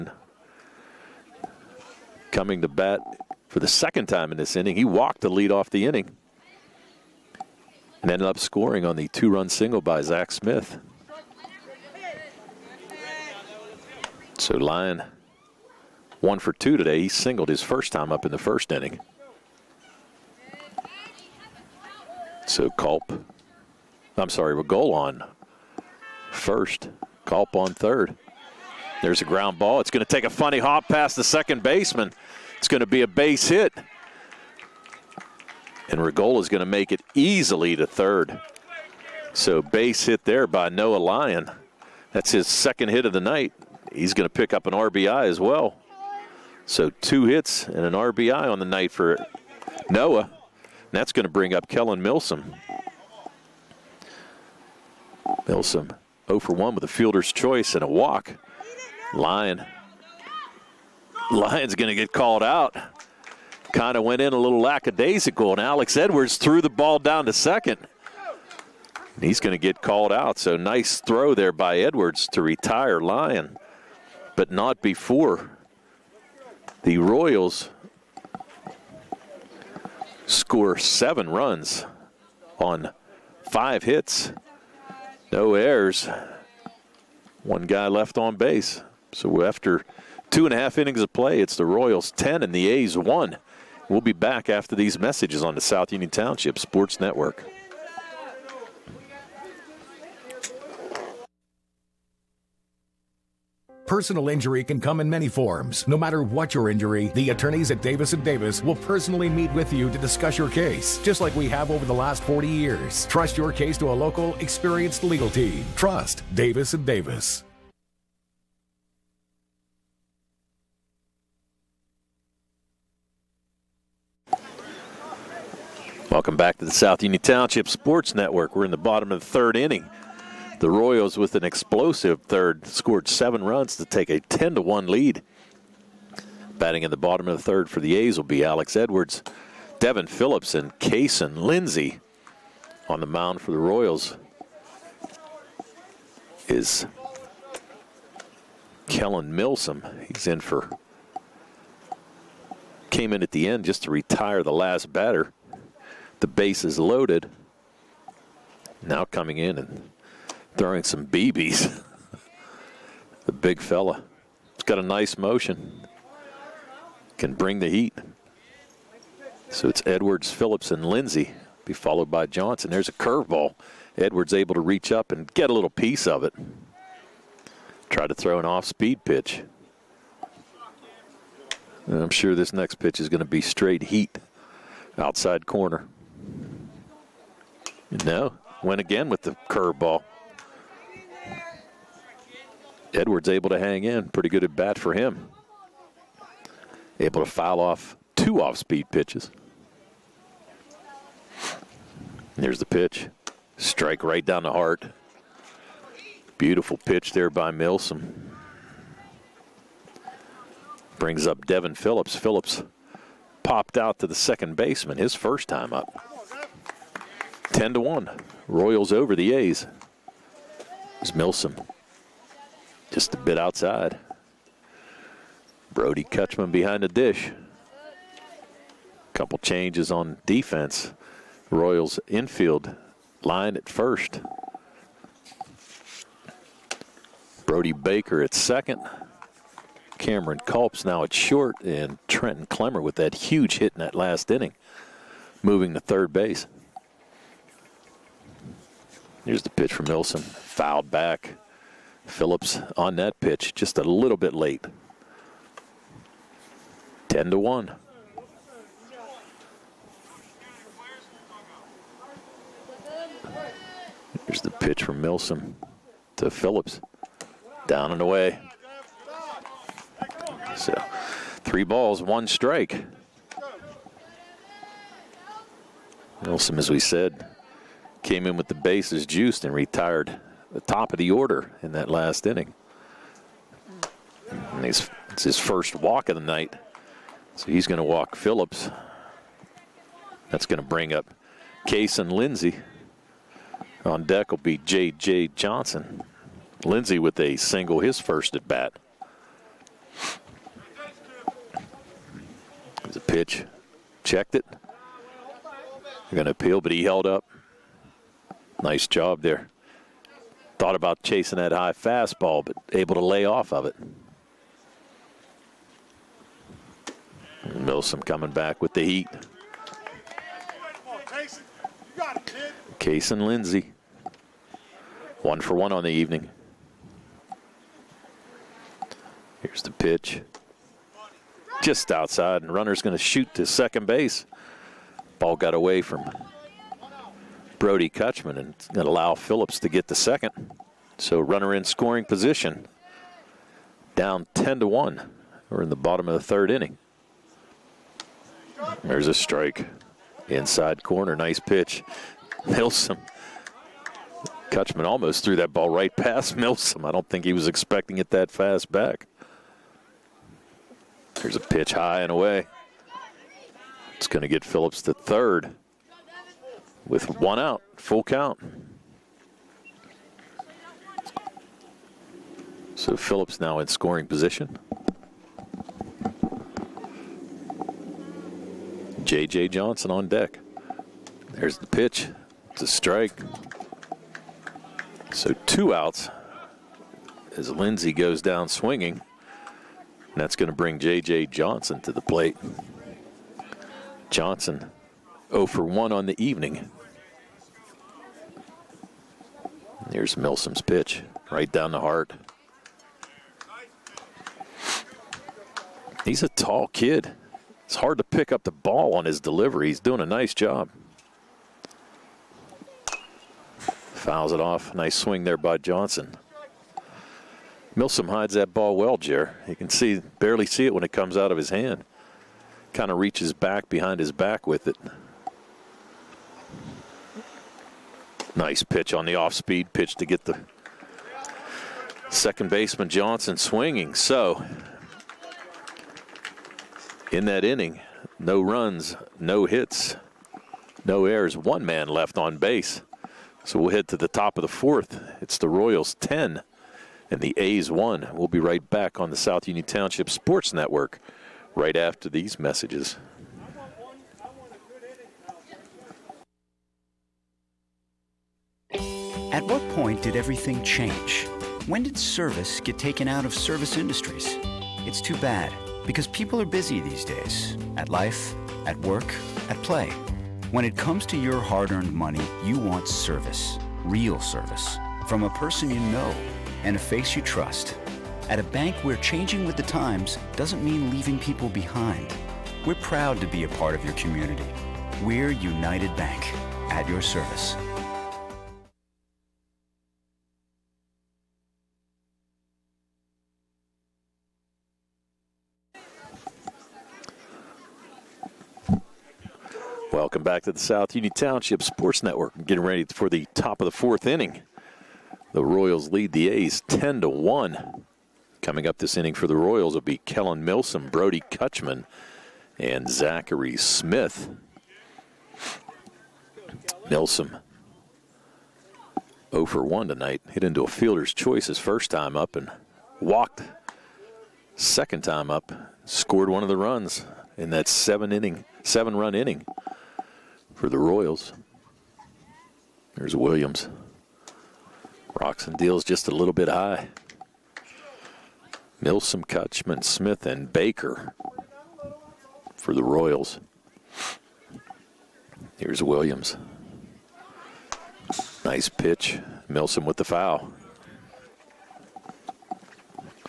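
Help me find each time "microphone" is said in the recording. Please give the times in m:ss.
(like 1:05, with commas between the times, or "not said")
not said.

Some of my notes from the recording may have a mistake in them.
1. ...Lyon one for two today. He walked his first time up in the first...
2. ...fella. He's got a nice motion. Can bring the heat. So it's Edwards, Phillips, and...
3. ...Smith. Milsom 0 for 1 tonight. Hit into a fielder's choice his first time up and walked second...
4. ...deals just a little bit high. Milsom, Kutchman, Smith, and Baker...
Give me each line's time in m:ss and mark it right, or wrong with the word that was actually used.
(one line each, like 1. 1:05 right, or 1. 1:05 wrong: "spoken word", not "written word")
1. 0:14 wrong: "singled", not "walked"
2. 2:43 right
3. 8:33 right
4. 8:55 right.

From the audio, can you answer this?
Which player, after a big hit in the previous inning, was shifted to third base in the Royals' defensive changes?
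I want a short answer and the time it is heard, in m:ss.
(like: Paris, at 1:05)
Trenton Clemmer, at 4:02.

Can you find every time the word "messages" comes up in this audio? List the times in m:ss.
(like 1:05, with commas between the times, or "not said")
1:34, 7:32.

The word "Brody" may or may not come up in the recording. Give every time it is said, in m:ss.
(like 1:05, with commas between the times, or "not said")
3:45, 3:57, 5:37, 8:30.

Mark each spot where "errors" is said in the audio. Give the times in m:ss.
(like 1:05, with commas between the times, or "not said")
1:25, 7:21.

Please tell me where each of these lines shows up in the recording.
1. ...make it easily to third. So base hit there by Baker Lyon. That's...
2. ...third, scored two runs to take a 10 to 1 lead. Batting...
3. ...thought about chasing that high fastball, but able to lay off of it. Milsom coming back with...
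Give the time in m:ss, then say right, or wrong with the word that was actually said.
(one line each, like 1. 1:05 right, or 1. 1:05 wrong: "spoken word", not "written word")
1. 0:36 wrong: "Noah", not "Baker"
2. 2:12 wrong: "seven", not "two"
3. 5:10 right.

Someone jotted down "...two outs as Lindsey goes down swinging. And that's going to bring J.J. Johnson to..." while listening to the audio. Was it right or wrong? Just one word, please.
right.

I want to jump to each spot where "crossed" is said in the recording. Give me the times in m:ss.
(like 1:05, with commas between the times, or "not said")
not said.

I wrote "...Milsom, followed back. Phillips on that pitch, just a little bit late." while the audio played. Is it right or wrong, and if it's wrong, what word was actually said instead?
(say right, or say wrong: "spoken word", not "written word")
wrong: "fouled", not "followed".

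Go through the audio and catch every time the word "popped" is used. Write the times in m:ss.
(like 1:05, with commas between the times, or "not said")
3:33.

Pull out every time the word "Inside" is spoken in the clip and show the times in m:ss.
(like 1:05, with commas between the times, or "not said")
5:50.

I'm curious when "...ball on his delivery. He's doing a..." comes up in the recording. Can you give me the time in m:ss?
6:48.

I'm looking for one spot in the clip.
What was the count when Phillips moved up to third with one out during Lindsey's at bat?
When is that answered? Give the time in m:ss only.
6:07.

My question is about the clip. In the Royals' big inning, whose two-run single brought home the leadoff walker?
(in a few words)
Zach Smith.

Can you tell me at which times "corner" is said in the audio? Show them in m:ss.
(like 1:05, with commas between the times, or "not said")
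3:05, 5:50.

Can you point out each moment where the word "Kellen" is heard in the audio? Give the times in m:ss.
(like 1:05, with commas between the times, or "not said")
0:51, 2:28, 8:30.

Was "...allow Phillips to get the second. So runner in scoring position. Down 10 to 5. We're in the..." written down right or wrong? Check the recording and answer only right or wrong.
wrong.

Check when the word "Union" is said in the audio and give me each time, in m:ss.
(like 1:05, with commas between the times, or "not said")
1:35, 2:07, 7:29, 8:20.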